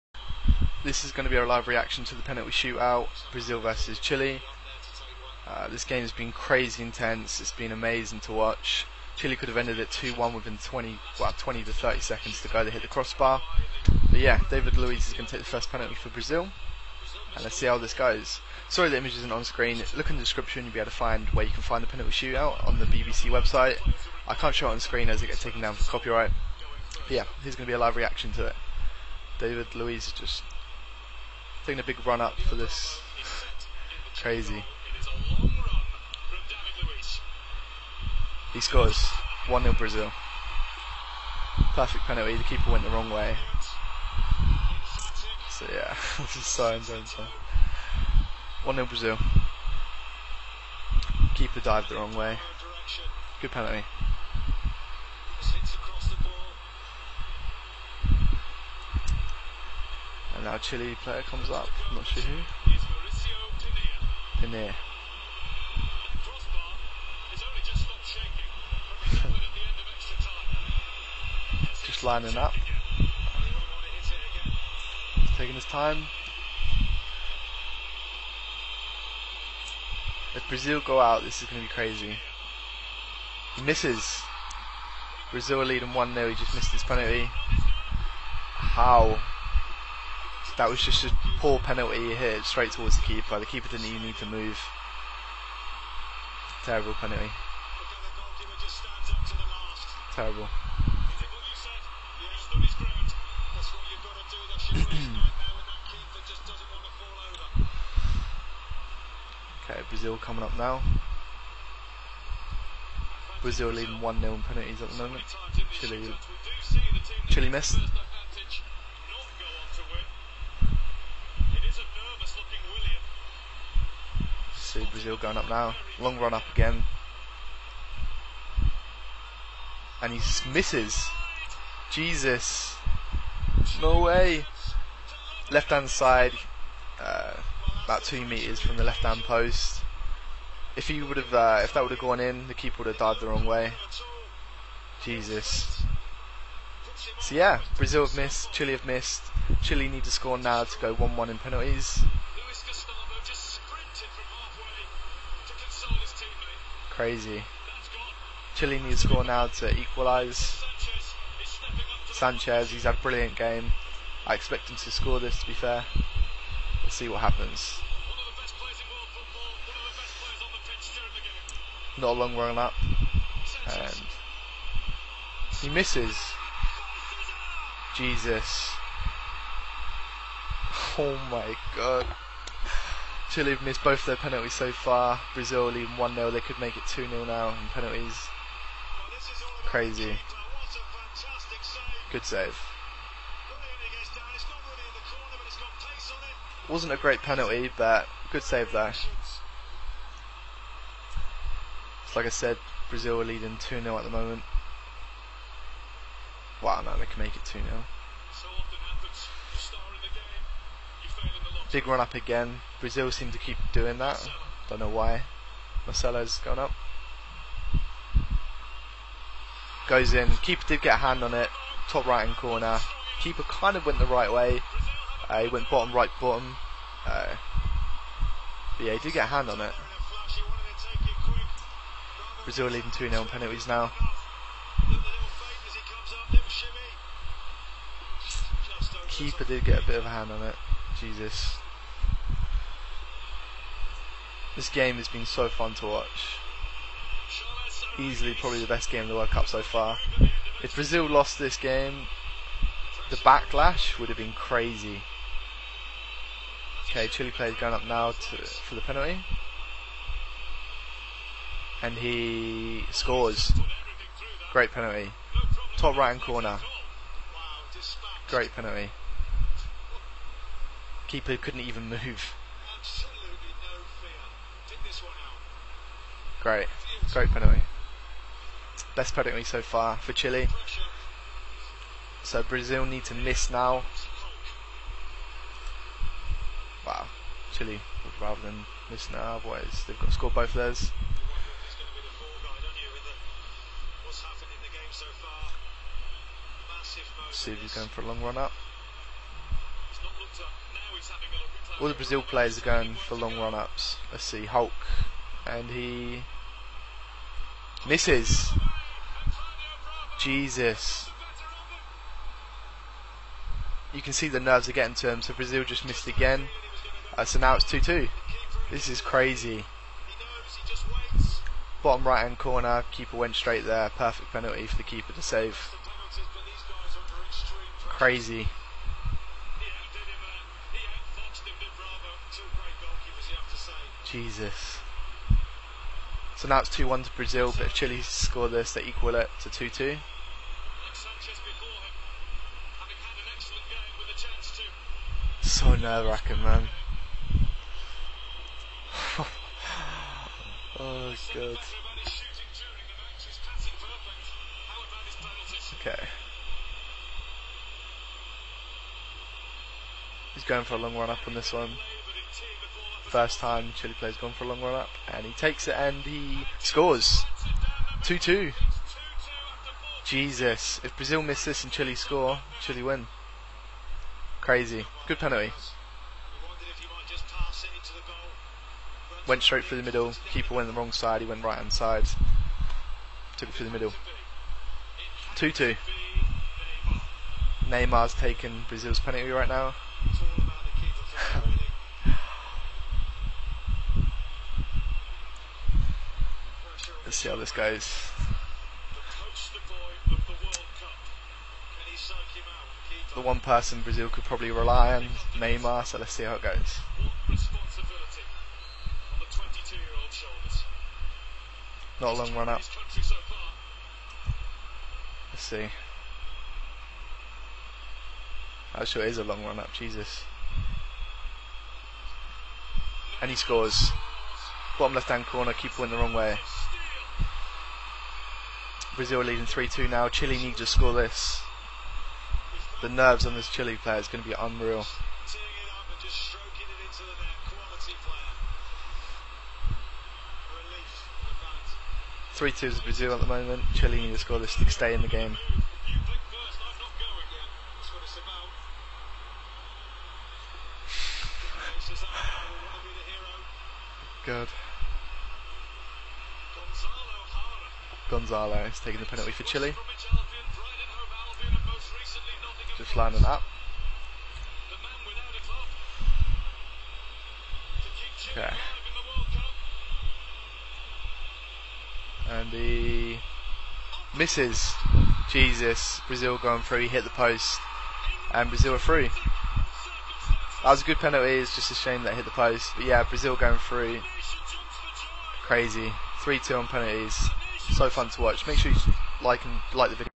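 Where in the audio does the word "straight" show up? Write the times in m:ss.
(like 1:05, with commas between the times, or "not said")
1:32, 5:23, 6:19.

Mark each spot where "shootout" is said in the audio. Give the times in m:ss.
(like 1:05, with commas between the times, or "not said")
0:02, 0:22.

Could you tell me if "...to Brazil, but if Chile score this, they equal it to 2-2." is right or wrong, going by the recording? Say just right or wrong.
right.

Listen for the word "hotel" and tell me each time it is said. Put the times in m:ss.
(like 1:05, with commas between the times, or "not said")
not said.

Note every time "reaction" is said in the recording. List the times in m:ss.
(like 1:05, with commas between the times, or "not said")
0:01, 0:27.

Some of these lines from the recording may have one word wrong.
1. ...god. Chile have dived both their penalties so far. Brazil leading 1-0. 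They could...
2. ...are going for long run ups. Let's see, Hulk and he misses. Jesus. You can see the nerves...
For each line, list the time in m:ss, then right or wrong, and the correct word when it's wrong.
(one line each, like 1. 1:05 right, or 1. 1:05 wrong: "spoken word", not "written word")
1. 3:01 wrong: "missed", not "dived"
2. 5:02 right.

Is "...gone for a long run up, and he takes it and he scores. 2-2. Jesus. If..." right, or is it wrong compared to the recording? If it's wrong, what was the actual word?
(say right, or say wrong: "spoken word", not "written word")
right.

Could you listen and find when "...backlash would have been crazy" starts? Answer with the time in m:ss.
4:13.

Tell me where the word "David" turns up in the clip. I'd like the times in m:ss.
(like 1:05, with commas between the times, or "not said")
0:14, 0:29.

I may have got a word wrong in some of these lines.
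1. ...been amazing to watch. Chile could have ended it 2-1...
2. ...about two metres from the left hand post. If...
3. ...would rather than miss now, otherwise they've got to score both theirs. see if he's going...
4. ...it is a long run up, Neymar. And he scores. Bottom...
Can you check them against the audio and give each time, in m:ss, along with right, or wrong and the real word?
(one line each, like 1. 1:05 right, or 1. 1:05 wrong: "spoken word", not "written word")
1. 0:07 right
2. 2:17 right
3. 4:48 right
4. 6:59 wrong: "Jesus", not "Neymar".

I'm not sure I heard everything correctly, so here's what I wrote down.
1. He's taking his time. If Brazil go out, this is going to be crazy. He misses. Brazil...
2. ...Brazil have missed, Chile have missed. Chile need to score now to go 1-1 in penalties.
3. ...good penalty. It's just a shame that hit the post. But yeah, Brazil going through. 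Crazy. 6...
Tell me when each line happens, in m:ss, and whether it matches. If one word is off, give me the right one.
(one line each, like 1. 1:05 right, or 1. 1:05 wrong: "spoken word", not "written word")
1. 1:15 right
2. 2:27 right
3. 8:00 wrong: "3", not "6".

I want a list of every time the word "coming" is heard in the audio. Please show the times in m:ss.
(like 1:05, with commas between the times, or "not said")
1:50.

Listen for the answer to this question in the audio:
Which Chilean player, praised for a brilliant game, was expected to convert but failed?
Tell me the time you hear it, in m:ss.
2:42.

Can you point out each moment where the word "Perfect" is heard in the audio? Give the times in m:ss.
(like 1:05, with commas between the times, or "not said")
0:41, 5:23.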